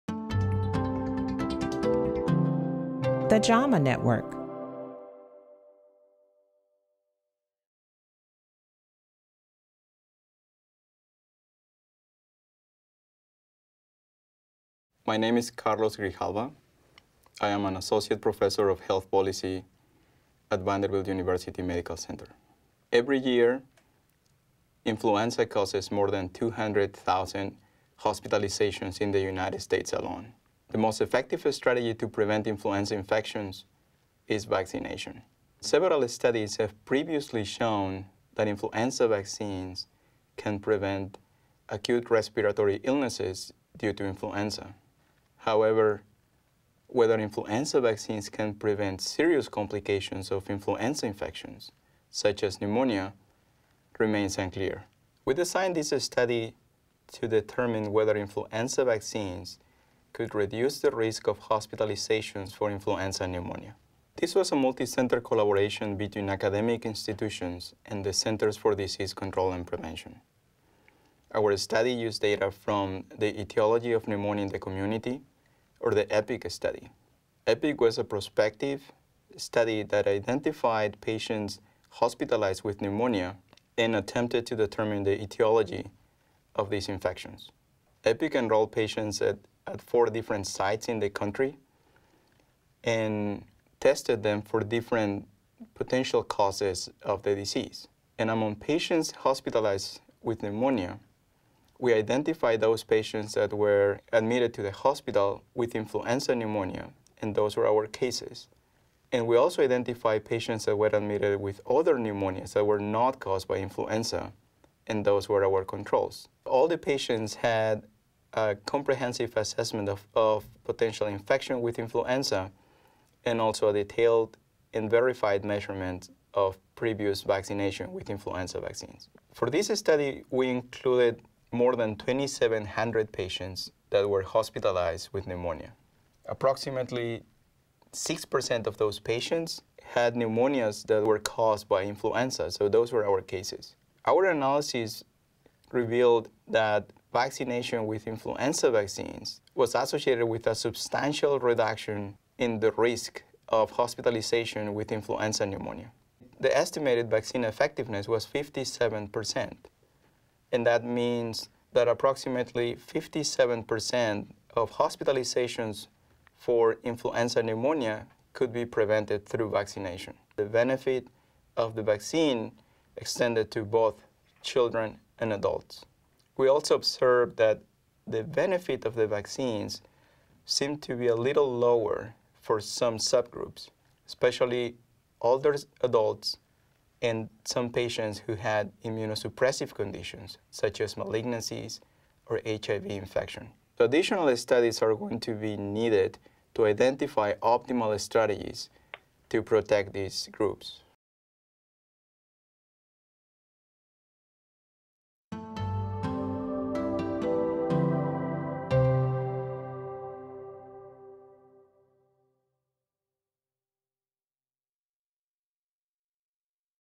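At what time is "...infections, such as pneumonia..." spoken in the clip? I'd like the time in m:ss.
0:51.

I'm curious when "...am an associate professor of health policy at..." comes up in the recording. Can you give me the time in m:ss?
0:17.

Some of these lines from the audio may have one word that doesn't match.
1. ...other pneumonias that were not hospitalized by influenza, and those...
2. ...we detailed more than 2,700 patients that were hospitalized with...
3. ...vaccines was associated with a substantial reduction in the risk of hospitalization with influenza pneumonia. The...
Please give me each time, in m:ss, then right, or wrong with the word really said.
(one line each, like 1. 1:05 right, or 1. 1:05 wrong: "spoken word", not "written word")
1. 1:51 wrong: "caused", not "hospitalized"
2. 2:10 wrong: "included", not "detailed"
3. 2:28 right.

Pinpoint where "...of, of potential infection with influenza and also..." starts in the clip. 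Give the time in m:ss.
1:59.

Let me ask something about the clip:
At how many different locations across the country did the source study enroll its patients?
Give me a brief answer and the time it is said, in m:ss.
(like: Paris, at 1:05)
4, at 1:29.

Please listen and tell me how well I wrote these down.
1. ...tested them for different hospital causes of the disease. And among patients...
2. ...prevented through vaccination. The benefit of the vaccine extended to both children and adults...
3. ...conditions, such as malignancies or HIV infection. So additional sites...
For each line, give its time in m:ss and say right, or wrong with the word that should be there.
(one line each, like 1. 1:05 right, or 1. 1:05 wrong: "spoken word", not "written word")
1. 1:33 wrong: "potential", not "hospital"
2. 2:48 right
3. 3:09 wrong: "studies", not "sites".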